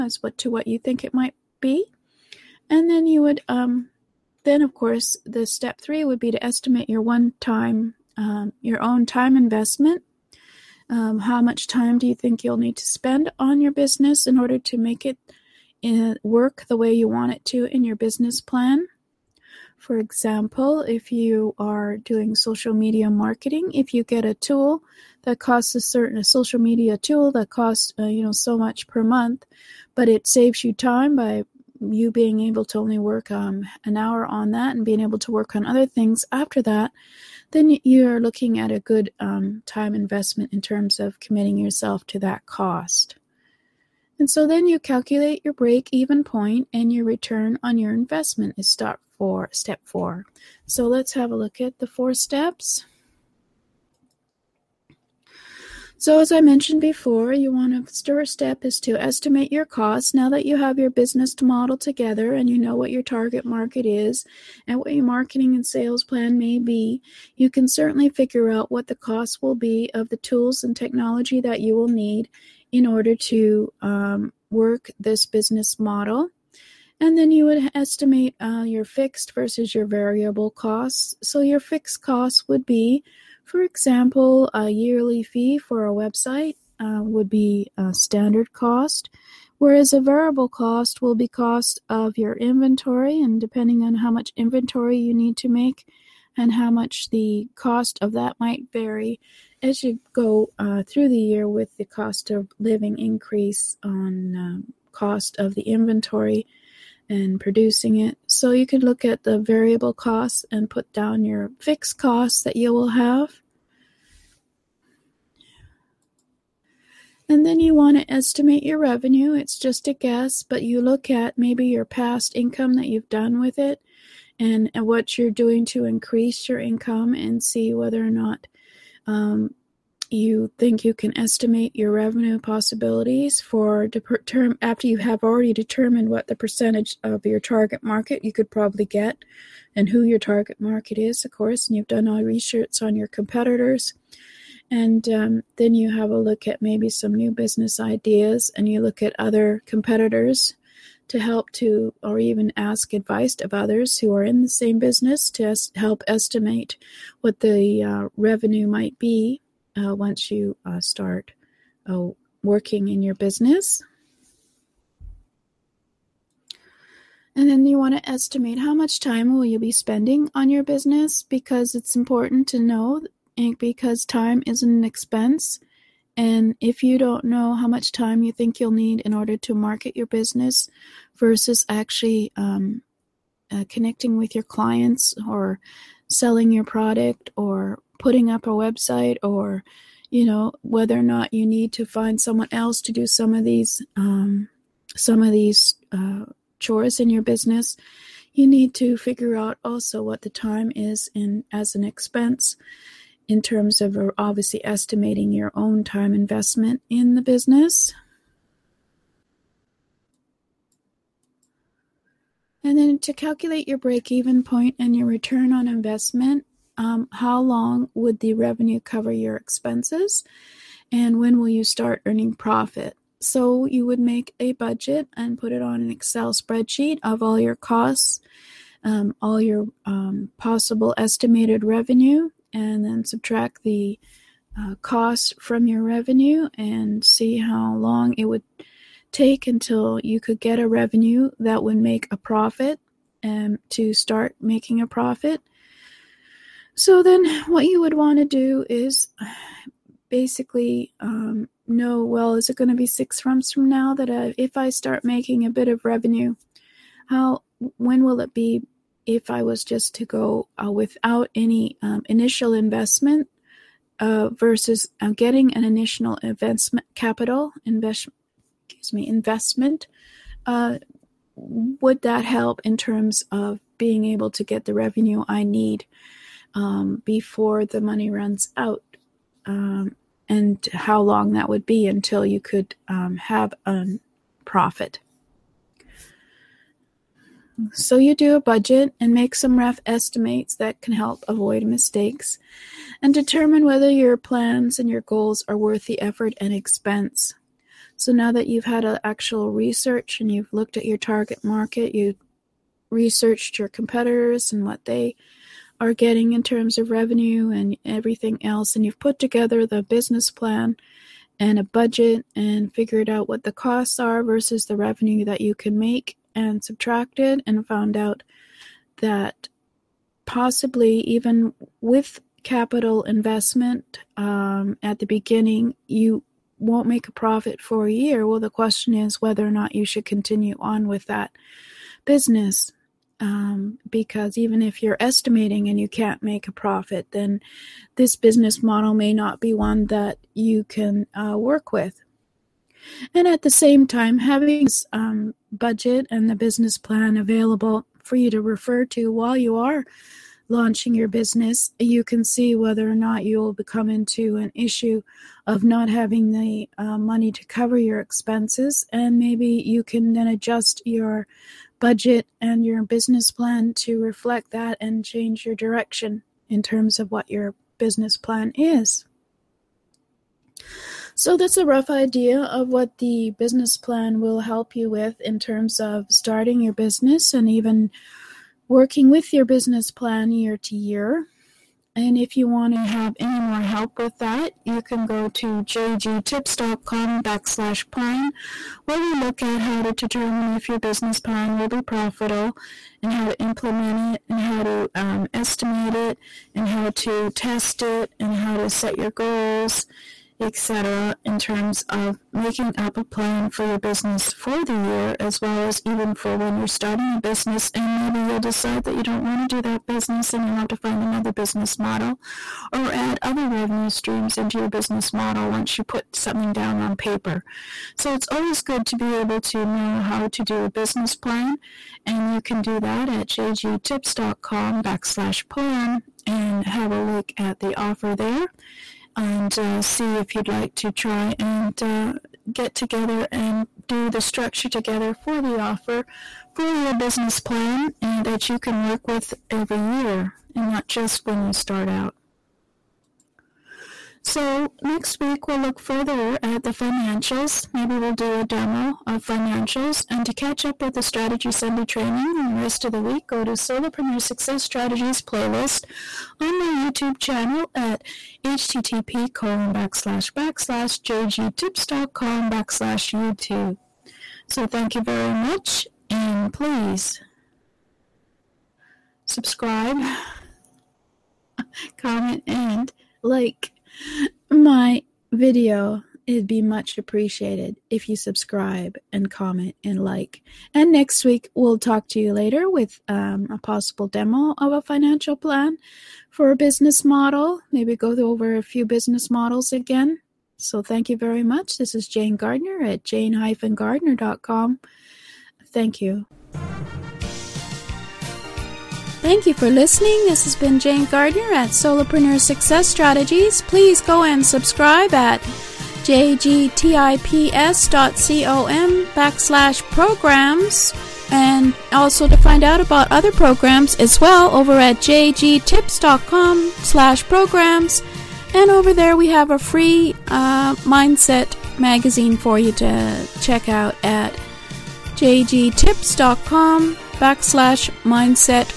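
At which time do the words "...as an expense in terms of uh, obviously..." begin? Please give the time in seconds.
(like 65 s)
201 s.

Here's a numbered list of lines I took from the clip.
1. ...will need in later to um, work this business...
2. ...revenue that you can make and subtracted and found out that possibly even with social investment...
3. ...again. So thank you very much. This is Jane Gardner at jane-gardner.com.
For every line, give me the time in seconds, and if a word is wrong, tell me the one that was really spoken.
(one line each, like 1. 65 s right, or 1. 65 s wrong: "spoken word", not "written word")
1. 71 s wrong: "order", not "later"
2. 314 s wrong: "capital", not "social"
3. 489 s right.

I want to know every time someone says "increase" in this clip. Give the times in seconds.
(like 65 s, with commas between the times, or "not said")
102 s, 125 s.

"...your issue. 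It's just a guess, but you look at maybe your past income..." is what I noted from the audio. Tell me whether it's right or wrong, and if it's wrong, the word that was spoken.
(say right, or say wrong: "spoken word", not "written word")
wrong: "revenue", not "issue".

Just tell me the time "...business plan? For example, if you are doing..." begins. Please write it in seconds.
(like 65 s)
17 s.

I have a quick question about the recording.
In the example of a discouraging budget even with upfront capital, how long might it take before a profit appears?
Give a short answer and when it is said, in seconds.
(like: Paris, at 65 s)
a year, at 327 s.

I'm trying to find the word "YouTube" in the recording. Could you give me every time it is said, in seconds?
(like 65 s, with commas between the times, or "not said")
456 s, 463 s.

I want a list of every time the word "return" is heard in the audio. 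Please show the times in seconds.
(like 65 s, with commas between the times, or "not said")
47 s, 215 s.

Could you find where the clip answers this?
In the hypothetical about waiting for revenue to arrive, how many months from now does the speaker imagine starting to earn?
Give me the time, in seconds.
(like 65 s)
252 s.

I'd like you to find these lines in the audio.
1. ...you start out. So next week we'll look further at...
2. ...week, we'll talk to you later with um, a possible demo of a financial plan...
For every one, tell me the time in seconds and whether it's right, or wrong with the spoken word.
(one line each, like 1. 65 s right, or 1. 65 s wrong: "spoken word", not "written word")
1. 441 s right
2. 481 s right.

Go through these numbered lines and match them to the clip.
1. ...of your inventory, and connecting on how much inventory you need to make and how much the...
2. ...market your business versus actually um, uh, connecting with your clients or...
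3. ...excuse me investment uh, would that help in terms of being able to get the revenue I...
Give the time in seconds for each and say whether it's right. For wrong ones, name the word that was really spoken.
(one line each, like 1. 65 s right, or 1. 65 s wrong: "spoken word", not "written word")
1. 91 s wrong: "depending", not "connecting"
2. 179 s right
3. 268 s right.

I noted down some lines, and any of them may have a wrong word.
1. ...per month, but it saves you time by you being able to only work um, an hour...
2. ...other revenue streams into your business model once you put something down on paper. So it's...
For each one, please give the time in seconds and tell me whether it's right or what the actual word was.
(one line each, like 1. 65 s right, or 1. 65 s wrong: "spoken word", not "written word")
1. 28 s right
2. 413 s right.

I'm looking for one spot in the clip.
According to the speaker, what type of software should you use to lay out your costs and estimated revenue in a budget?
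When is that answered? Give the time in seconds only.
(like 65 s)
225 s.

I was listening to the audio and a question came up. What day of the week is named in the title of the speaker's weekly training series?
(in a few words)
Sunday.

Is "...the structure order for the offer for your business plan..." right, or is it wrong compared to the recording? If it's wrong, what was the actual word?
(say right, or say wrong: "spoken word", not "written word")
wrong: "together", not "order".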